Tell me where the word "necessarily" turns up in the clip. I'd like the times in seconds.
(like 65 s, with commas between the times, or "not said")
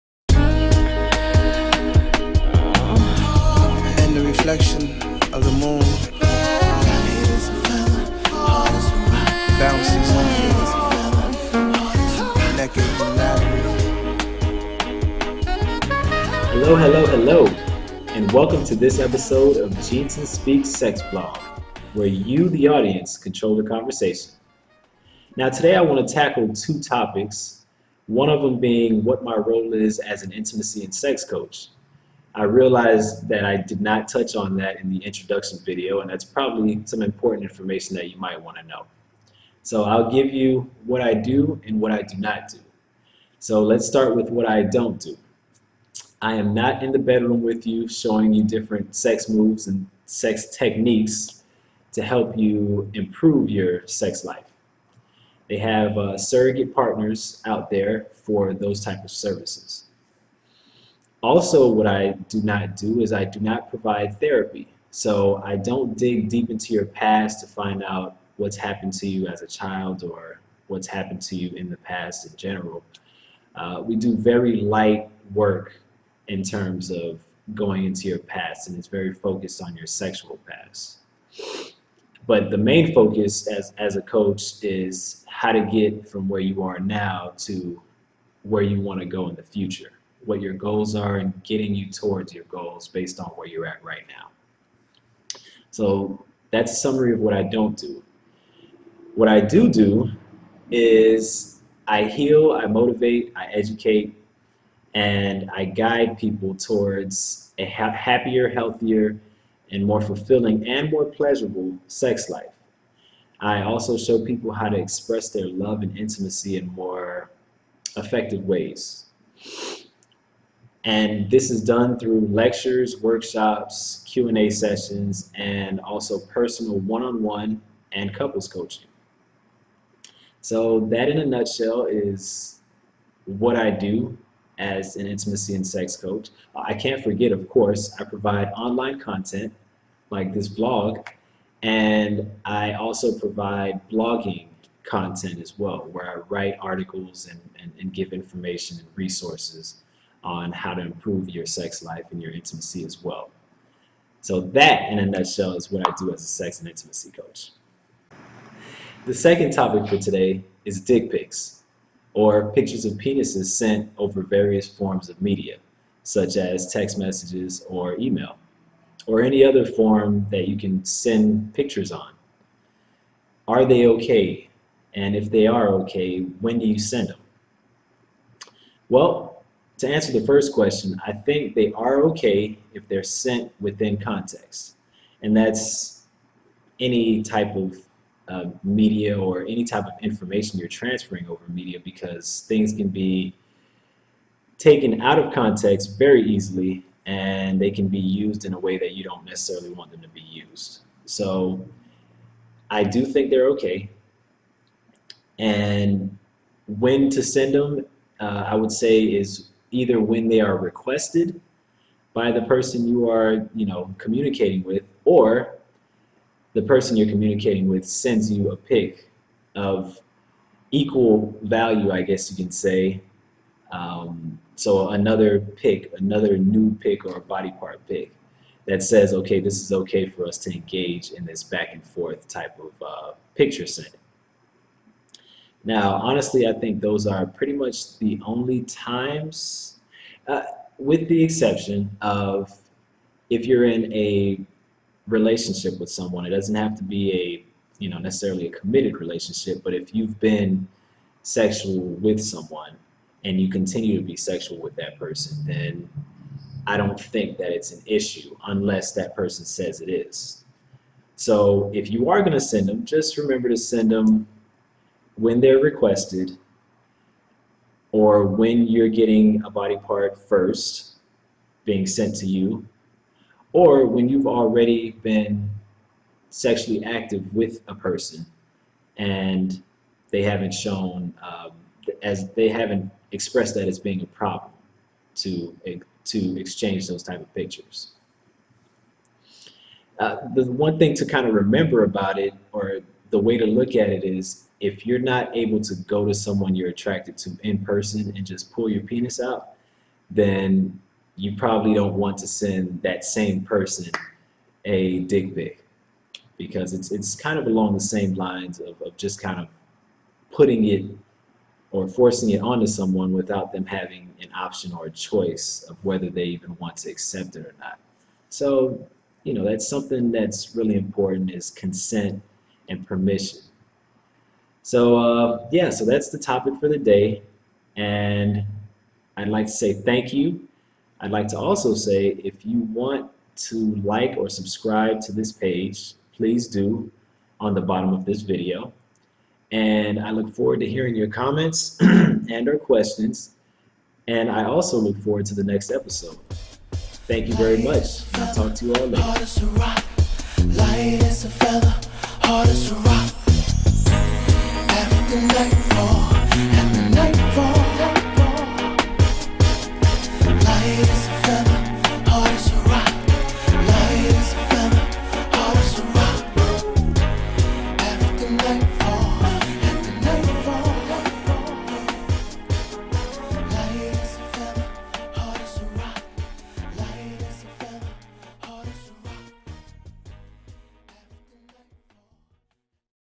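199 s, 247 s.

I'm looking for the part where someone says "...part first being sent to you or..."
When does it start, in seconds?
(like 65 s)
269 s.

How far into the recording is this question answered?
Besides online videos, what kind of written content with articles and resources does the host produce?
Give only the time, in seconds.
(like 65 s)
143 s.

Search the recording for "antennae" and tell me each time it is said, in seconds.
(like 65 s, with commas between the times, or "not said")
not said.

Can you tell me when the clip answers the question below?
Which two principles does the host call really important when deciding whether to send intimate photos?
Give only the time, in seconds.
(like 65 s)
321 s.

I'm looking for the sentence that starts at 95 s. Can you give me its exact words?
So that's a summary of what I don't do.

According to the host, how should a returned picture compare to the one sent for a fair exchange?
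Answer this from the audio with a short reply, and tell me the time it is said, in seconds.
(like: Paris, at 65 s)
equal value, at 220 s.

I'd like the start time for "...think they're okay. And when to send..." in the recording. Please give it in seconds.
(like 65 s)
203 s.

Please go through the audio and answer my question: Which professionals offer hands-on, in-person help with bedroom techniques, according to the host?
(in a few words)
surrogate partners.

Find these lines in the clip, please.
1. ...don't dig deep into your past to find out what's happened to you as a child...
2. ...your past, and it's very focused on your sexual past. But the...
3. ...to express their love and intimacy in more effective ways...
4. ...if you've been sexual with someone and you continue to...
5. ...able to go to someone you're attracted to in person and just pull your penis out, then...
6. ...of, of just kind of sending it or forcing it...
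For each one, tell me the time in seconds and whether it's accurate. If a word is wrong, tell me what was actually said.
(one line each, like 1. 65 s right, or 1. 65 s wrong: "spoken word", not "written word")
1. 65 s right
2. 78 s right
3. 114 s right
4. 249 s right
5. 295 s right
6. 308 s wrong: "putting", not "sending".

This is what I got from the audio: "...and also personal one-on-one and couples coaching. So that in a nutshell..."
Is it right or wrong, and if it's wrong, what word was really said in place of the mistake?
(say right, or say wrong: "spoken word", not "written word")
right.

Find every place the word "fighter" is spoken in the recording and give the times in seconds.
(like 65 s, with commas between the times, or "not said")
not said.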